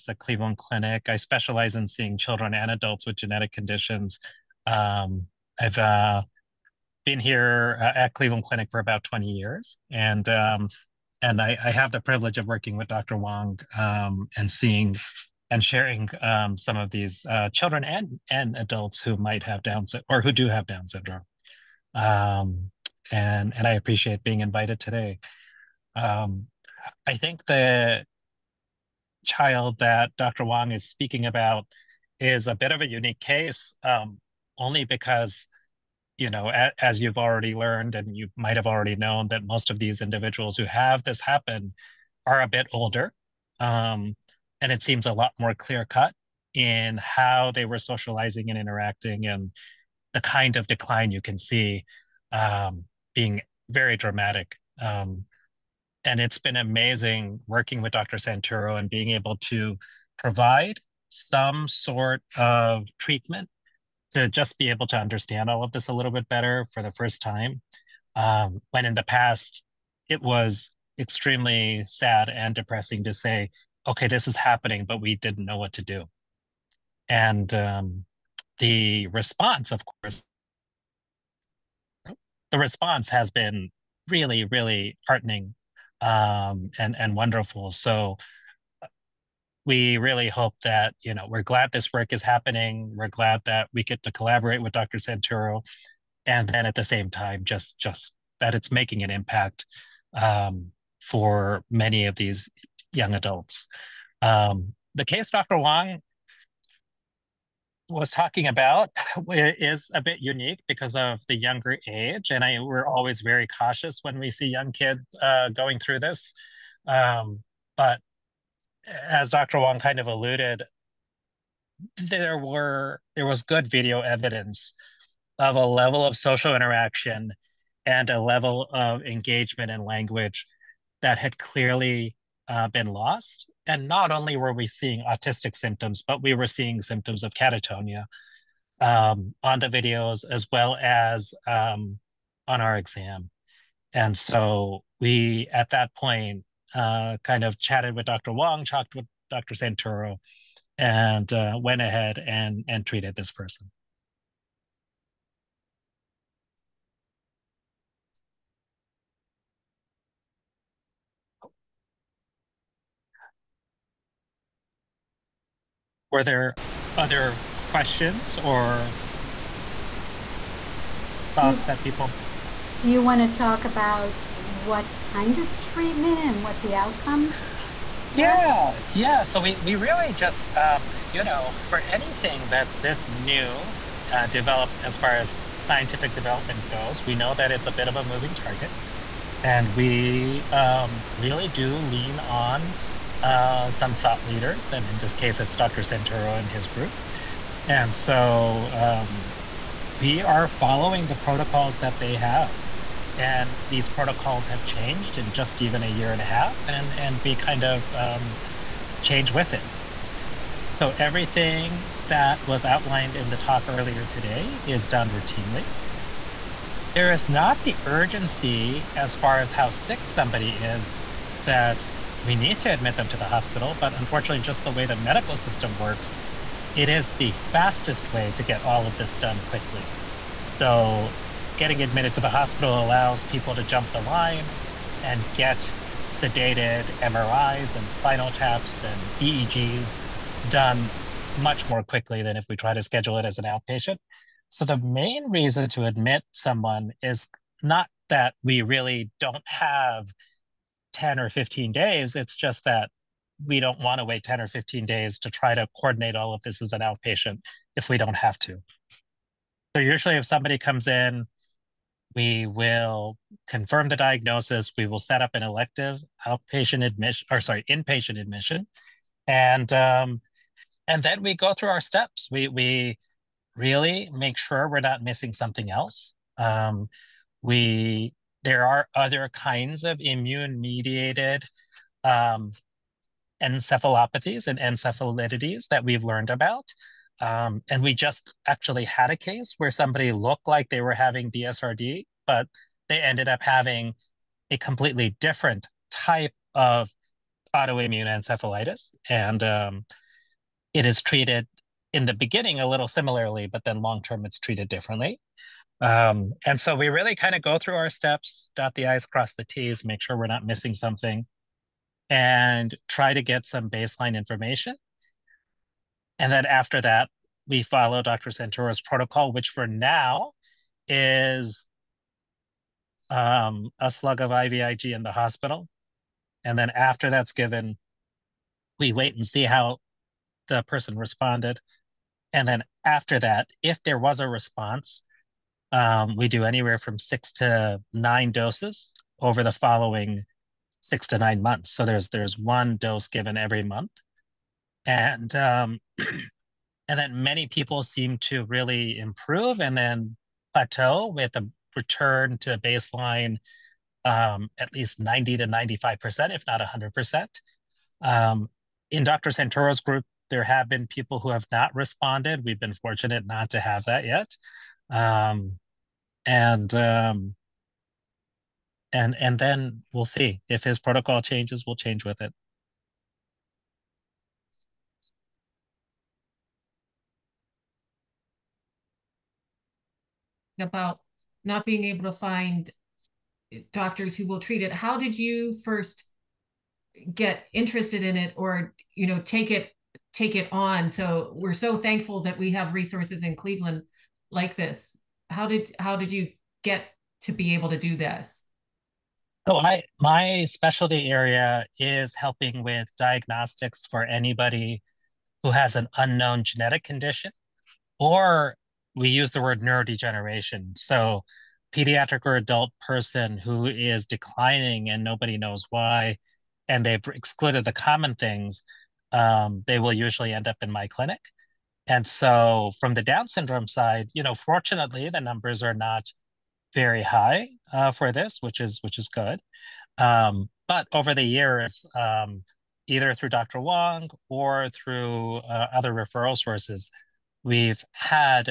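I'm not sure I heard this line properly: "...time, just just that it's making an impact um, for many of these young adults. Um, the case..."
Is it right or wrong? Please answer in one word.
right.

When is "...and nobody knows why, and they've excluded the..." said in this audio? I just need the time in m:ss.
6:54.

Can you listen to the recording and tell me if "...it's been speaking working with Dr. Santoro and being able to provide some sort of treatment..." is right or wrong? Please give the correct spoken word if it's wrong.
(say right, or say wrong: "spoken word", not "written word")
wrong: "amazing", not "speaking".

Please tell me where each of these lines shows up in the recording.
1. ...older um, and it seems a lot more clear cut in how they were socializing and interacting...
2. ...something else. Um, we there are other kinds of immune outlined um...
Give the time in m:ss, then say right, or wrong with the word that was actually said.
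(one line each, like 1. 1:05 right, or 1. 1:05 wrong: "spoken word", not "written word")
1. 0:42 right
2. 4:35 wrong: "mediated", not "outlined".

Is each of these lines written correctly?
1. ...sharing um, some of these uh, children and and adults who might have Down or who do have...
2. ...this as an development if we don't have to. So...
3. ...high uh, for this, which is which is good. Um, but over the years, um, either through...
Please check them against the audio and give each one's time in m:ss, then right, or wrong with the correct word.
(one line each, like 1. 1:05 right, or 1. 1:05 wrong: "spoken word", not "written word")
1. 0:15 right
2. 4:16 wrong: "outpatient", not "development"
3. 7:07 right.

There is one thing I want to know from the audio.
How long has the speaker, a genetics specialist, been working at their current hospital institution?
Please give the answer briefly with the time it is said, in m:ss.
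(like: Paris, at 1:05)
20 years, at 0:08.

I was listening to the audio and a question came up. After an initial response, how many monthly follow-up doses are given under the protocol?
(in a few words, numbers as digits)
6 to 9.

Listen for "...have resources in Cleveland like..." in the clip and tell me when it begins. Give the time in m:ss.
6:32.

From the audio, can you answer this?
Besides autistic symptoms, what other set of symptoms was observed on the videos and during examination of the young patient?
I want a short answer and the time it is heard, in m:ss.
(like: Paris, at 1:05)
Catatonia, at 2:17.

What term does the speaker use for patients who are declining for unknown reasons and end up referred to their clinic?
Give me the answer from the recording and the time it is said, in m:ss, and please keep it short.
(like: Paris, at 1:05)
Neurodegeneration, at 6:49.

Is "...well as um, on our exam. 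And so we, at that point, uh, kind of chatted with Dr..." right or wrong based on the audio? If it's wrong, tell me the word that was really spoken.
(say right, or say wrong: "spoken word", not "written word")
right.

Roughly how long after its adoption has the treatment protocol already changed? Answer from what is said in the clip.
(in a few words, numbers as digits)
A year and a half.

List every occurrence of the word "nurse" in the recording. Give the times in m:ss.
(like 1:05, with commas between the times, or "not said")
not said.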